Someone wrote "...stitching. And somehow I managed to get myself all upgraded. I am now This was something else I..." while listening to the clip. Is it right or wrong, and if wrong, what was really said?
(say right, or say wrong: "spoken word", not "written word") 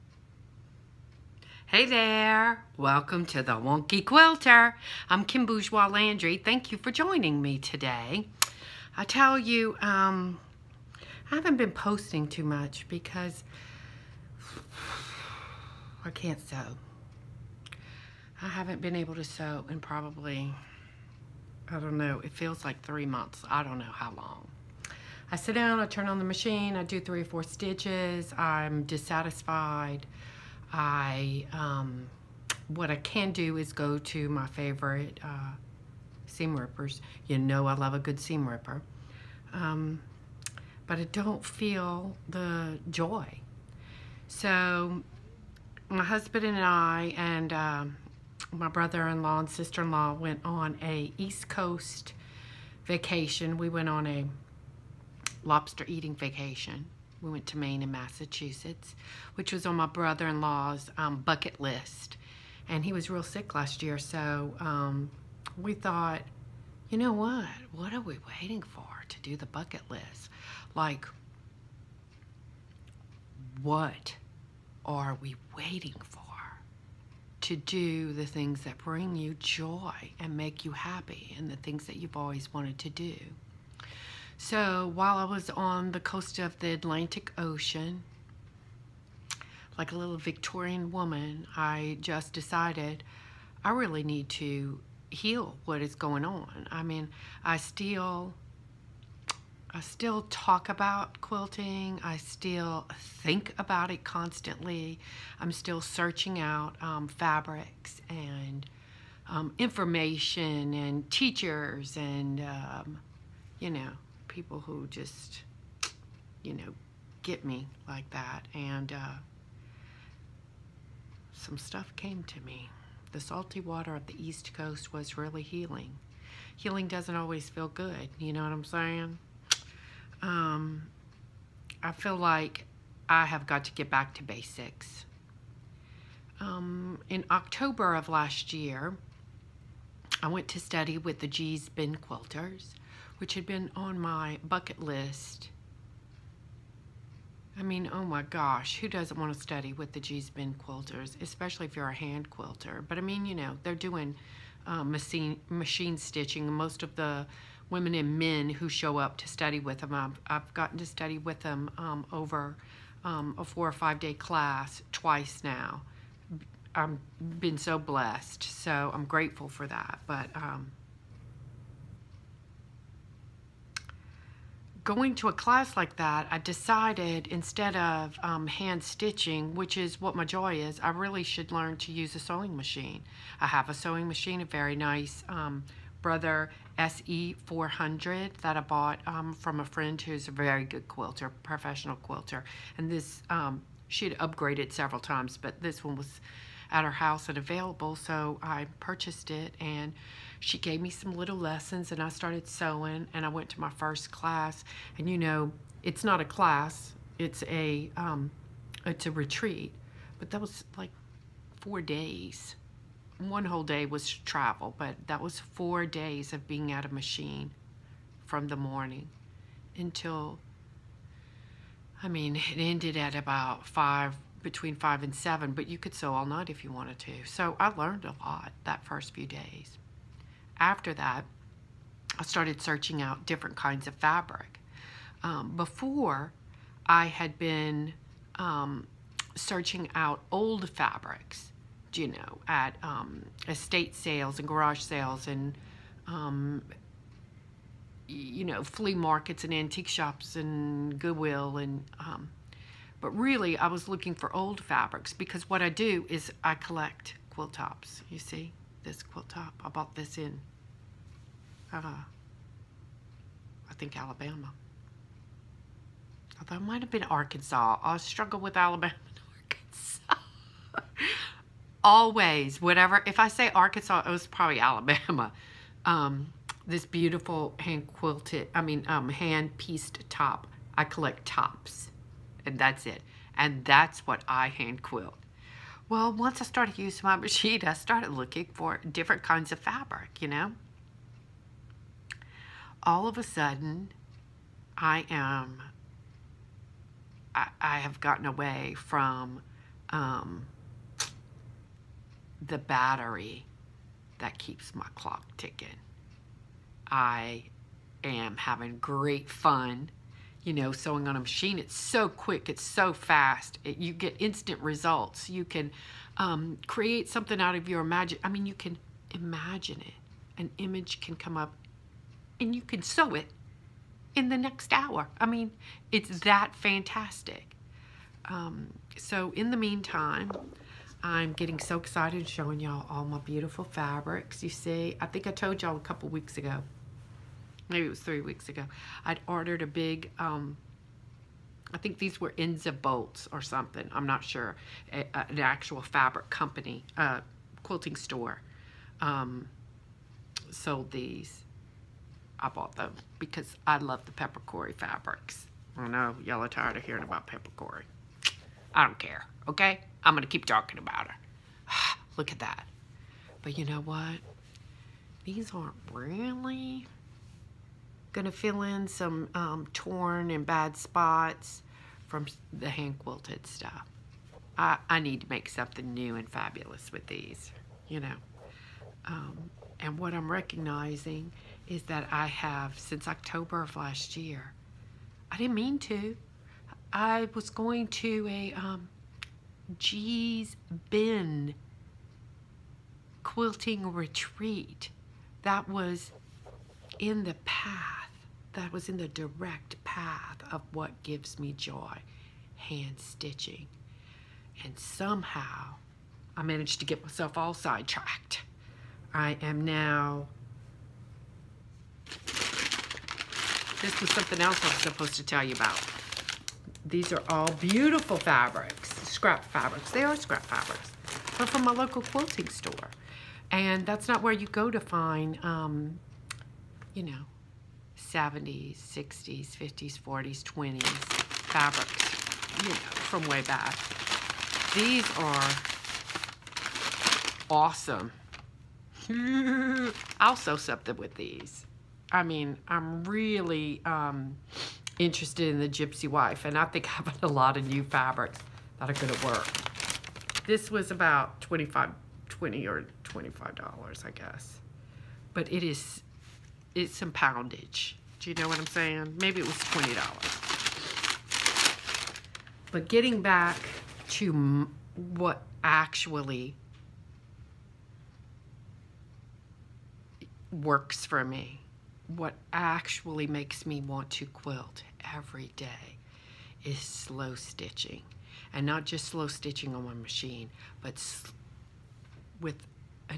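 wrong: "sidetracked", not "upgraded".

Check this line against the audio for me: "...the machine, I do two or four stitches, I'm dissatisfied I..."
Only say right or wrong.
wrong.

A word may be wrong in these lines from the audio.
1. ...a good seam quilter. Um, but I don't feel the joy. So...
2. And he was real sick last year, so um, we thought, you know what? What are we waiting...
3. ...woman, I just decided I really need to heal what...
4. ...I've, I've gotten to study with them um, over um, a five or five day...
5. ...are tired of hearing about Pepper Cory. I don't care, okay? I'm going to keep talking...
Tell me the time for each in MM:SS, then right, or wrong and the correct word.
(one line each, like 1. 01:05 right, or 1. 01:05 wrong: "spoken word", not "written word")
1. 00:37 wrong: "ripper", not "quilter"
2. 01:02 right
3. 01:30 right
4. 02:39 wrong: "four", not "five"
5. 05:56 right.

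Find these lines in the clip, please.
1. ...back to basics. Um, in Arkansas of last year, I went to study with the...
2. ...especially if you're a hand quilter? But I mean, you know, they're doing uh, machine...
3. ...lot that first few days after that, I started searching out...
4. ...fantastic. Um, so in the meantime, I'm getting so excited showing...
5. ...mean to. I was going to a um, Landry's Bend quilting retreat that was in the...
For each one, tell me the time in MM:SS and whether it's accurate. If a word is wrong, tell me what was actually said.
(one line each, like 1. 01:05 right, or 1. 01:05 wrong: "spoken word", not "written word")
1. 02:13 wrong: "October", not "Arkansas"
2. 02:31 right
3. 03:48 right
4. 05:26 right
5. 06:25 wrong: "Gee", not "Landry".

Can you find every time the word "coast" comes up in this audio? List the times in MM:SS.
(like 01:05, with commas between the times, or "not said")
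00:51, 01:25, 02:04.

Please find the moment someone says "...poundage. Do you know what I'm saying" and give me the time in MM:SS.
07:37.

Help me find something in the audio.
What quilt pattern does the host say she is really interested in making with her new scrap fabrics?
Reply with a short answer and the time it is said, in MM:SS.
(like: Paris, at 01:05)
Gypsy Wife, at 07:25.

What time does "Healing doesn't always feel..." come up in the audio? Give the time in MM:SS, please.
02:06.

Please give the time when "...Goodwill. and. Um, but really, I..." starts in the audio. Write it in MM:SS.
04:10.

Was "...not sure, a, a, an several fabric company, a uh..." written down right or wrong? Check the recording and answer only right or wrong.
wrong.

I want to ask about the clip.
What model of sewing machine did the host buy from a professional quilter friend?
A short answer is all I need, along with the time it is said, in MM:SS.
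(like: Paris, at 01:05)
Brother SE400, at 03:06.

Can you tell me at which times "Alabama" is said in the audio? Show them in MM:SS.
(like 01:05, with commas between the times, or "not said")
04:23, 04:28, 04:34.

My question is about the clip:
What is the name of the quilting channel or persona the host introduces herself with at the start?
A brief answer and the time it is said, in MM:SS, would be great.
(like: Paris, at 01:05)
the Wonky Quilter, at 00:03.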